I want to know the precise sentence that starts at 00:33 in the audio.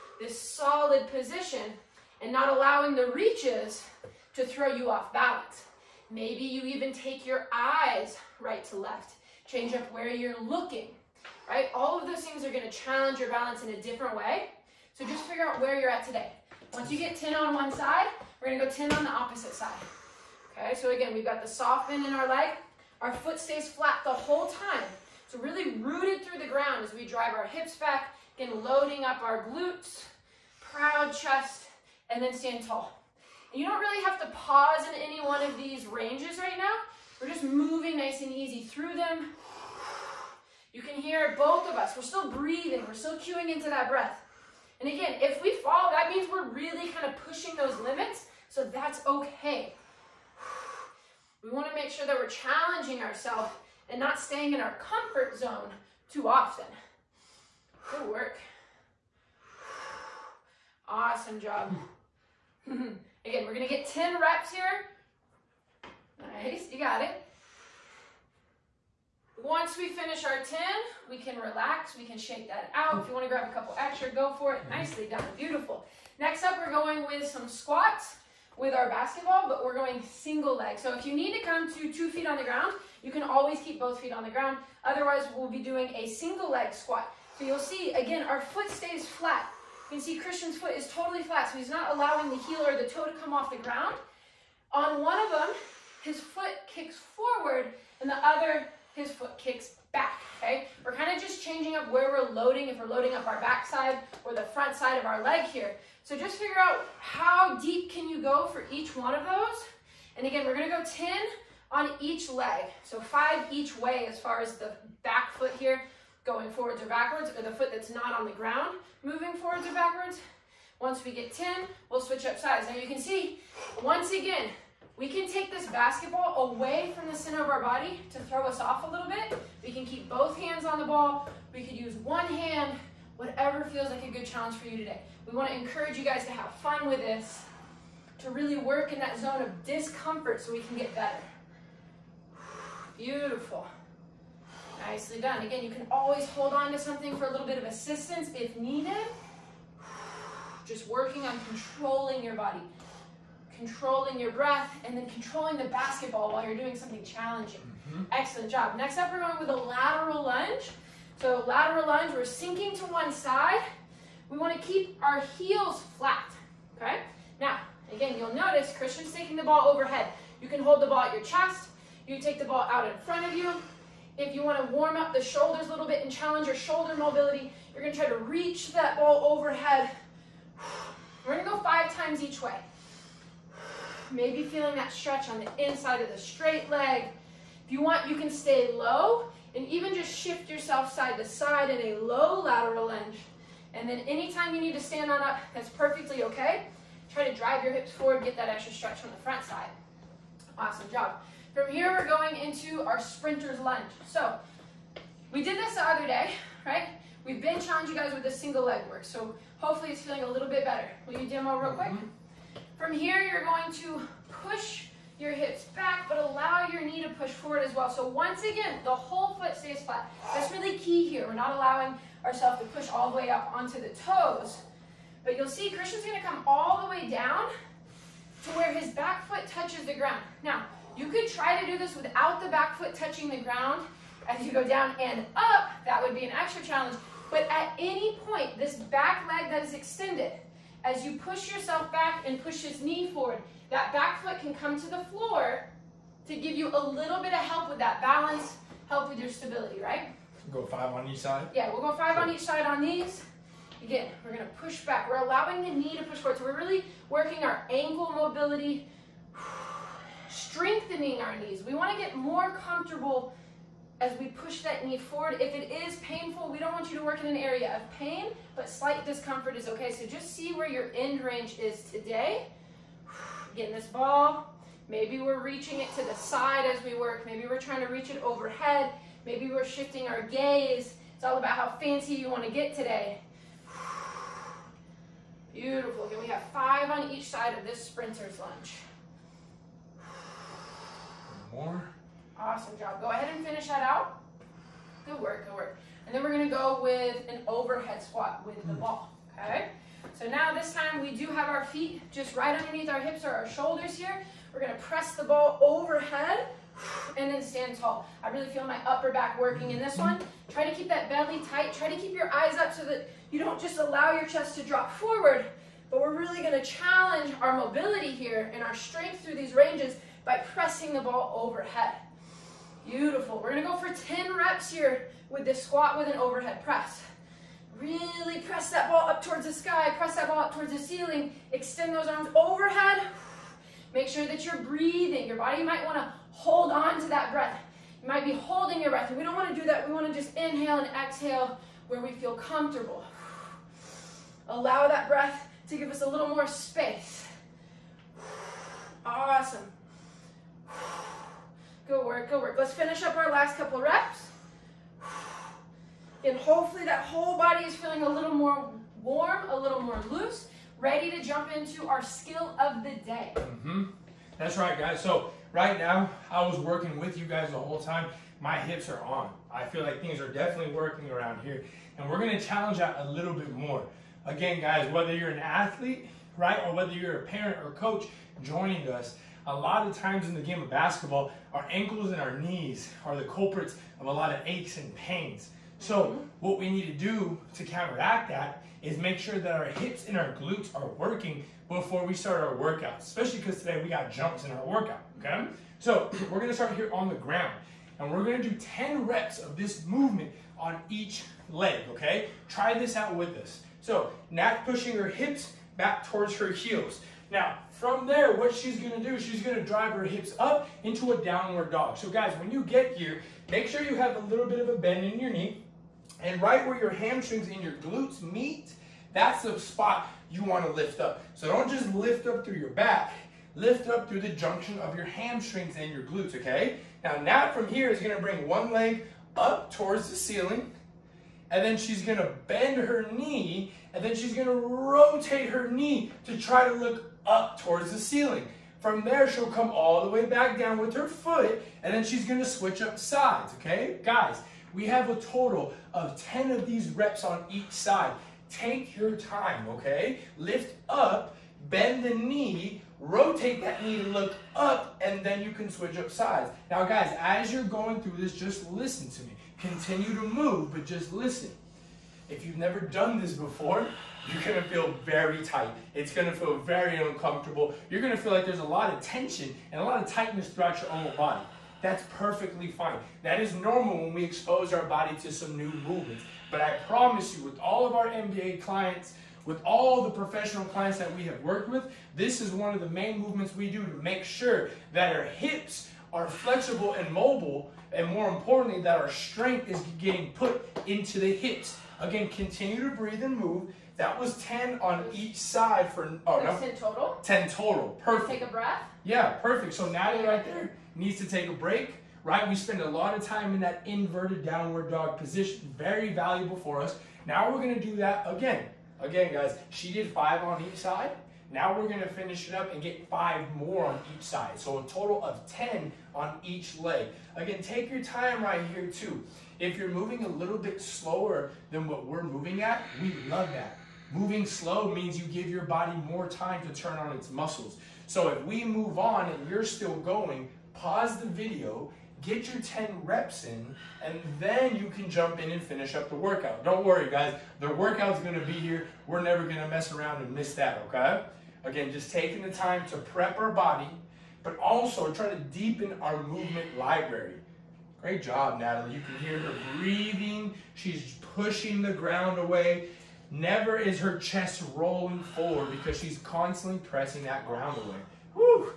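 And you don't really have to pause in any one of these ranges right now.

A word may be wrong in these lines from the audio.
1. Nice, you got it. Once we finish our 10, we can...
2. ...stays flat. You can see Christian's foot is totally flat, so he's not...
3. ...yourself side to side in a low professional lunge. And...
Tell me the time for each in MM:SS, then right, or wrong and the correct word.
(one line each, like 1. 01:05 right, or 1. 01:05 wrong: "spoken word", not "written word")
1. 01:06 right
2. 01:28 right
3. 03:10 wrong: "lateral", not "professional".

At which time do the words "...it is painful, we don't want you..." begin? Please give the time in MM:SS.
04:25.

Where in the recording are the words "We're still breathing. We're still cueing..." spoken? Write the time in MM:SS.
00:41.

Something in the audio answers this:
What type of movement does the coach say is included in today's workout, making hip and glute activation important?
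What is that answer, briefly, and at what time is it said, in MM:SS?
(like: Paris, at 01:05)
jumps, at 06:34.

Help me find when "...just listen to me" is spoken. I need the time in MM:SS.
07:38.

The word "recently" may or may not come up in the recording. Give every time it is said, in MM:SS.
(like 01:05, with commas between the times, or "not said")
not said.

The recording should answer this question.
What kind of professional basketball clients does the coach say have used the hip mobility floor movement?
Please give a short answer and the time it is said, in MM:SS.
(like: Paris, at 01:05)
NBA clients, at 07:58.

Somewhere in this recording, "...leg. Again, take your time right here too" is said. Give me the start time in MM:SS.
08:36.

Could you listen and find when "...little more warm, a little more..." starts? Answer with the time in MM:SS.
05:58.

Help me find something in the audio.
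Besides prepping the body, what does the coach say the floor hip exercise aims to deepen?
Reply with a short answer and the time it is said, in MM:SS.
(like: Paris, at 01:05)
movement library, at 09:06.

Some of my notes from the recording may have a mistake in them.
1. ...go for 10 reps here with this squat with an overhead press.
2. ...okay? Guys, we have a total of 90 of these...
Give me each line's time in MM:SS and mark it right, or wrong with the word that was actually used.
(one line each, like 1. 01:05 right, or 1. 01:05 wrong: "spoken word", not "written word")
1. 05:23 right
2. 07:23 wrong: "10", not "90".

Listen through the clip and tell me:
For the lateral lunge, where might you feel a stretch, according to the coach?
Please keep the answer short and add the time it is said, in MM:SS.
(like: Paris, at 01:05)
inside of the straight leg, at 03:05.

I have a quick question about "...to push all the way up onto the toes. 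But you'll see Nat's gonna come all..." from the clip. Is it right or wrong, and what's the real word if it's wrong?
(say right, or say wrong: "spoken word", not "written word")
wrong: "Christian", not "Nat".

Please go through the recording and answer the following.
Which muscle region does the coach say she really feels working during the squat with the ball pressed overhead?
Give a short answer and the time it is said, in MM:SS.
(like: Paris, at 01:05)
upper back, at 05:08.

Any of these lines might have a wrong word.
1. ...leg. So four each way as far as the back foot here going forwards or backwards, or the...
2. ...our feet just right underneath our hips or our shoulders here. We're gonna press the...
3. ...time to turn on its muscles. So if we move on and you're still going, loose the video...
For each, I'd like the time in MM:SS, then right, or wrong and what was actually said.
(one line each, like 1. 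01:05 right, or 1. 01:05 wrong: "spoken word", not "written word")
1. 01:52 wrong: "five", not "four"
2. 05:01 right
3. 08:46 wrong: "pause", not "loose".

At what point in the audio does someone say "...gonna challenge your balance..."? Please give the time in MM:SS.
00:12.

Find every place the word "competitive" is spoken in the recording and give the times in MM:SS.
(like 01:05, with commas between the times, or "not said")
not said.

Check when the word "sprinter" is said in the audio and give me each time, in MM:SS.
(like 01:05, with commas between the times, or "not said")
03:22, 04:47.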